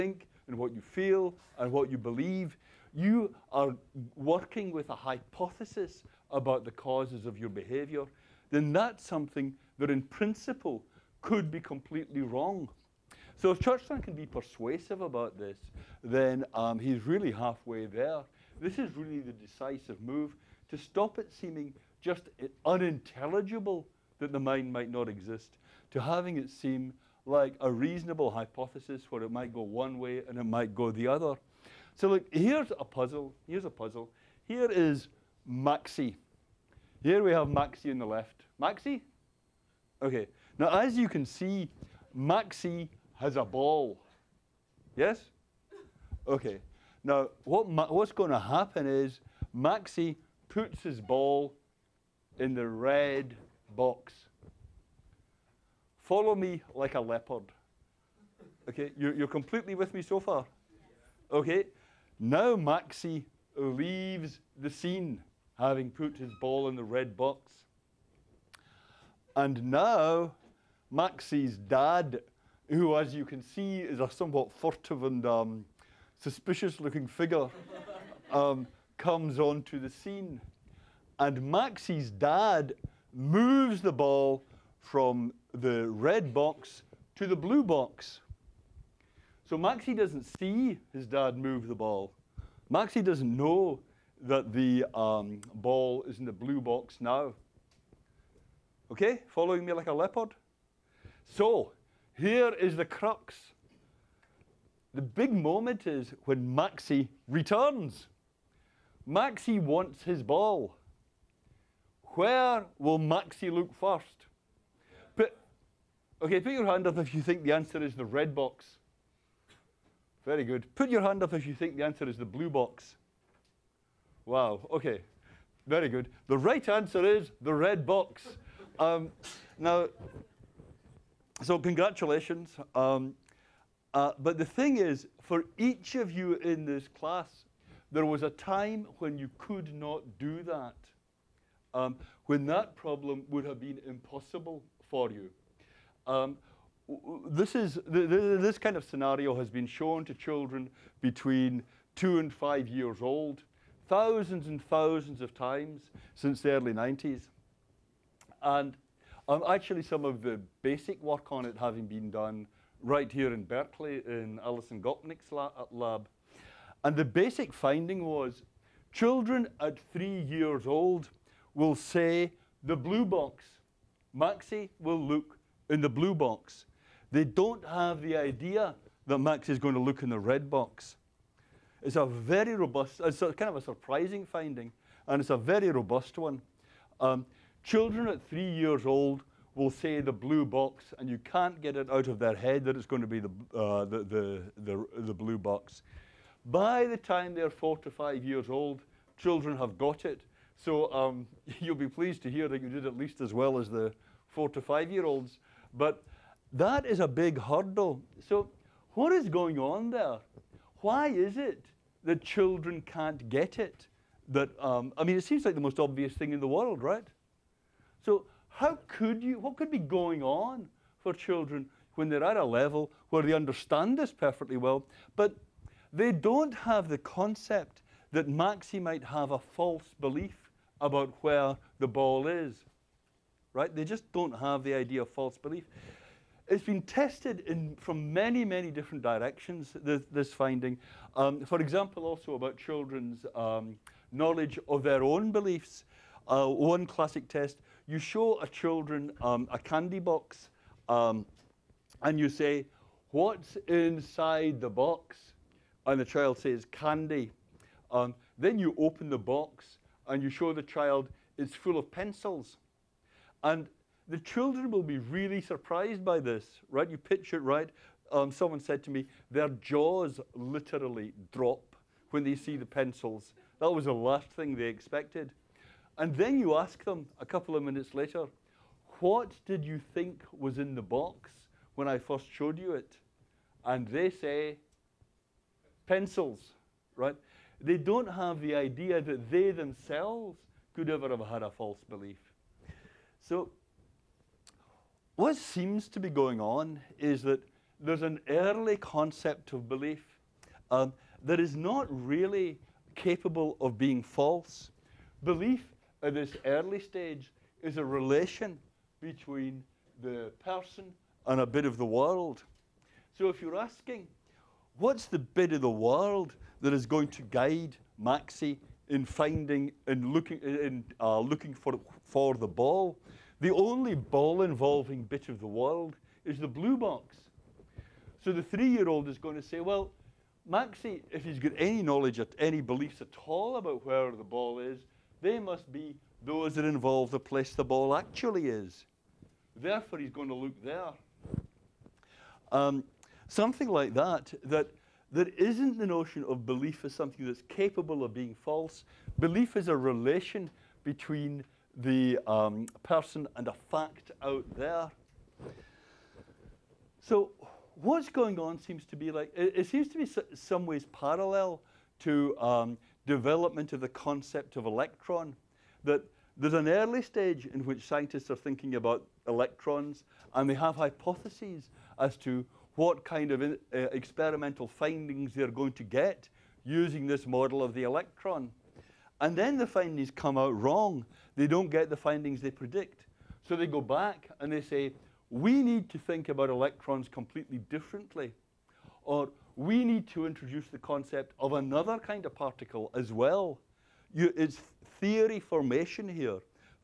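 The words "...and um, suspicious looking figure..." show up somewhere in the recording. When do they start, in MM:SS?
01:15.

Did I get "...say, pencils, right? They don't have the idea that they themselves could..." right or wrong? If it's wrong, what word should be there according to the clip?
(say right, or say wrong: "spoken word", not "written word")
right.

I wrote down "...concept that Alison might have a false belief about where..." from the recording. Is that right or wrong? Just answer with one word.
wrong.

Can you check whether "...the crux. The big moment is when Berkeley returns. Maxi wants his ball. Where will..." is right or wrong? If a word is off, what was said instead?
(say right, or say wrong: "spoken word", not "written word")
wrong: "Maxi", not "Berkeley".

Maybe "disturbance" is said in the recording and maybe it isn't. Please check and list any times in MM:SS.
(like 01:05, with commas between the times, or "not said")
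not said.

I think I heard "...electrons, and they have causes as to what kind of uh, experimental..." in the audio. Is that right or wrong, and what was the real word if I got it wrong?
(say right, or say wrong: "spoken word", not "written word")
wrong: "hypotheses", not "causes".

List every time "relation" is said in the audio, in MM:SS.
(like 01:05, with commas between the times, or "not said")
05:07, 05:49.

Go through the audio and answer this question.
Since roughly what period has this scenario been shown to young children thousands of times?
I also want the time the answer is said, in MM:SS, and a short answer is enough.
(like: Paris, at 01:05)
Early 90s, at 02:36.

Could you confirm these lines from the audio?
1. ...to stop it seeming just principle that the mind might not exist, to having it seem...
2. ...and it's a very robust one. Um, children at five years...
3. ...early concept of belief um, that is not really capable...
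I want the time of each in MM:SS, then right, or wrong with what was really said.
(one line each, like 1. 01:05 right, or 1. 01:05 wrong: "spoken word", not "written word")
1. 00:20 wrong: "unintelligible", not "principle"
2. 03:05 wrong: "three", not "five"
3. 04:58 right.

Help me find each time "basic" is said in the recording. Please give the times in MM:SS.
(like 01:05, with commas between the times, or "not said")
02:40, 02:47.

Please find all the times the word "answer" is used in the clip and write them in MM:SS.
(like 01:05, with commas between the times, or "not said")
01:57, 02:01, 02:06.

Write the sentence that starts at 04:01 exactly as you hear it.
Um, for example, also about children's um, knowledge of their own beliefs.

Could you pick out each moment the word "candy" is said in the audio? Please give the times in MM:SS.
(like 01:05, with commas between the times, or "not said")
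04:09, 04:16.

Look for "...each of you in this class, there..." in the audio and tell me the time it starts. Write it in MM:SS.
02:15.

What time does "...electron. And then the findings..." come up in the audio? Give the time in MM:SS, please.
06:17.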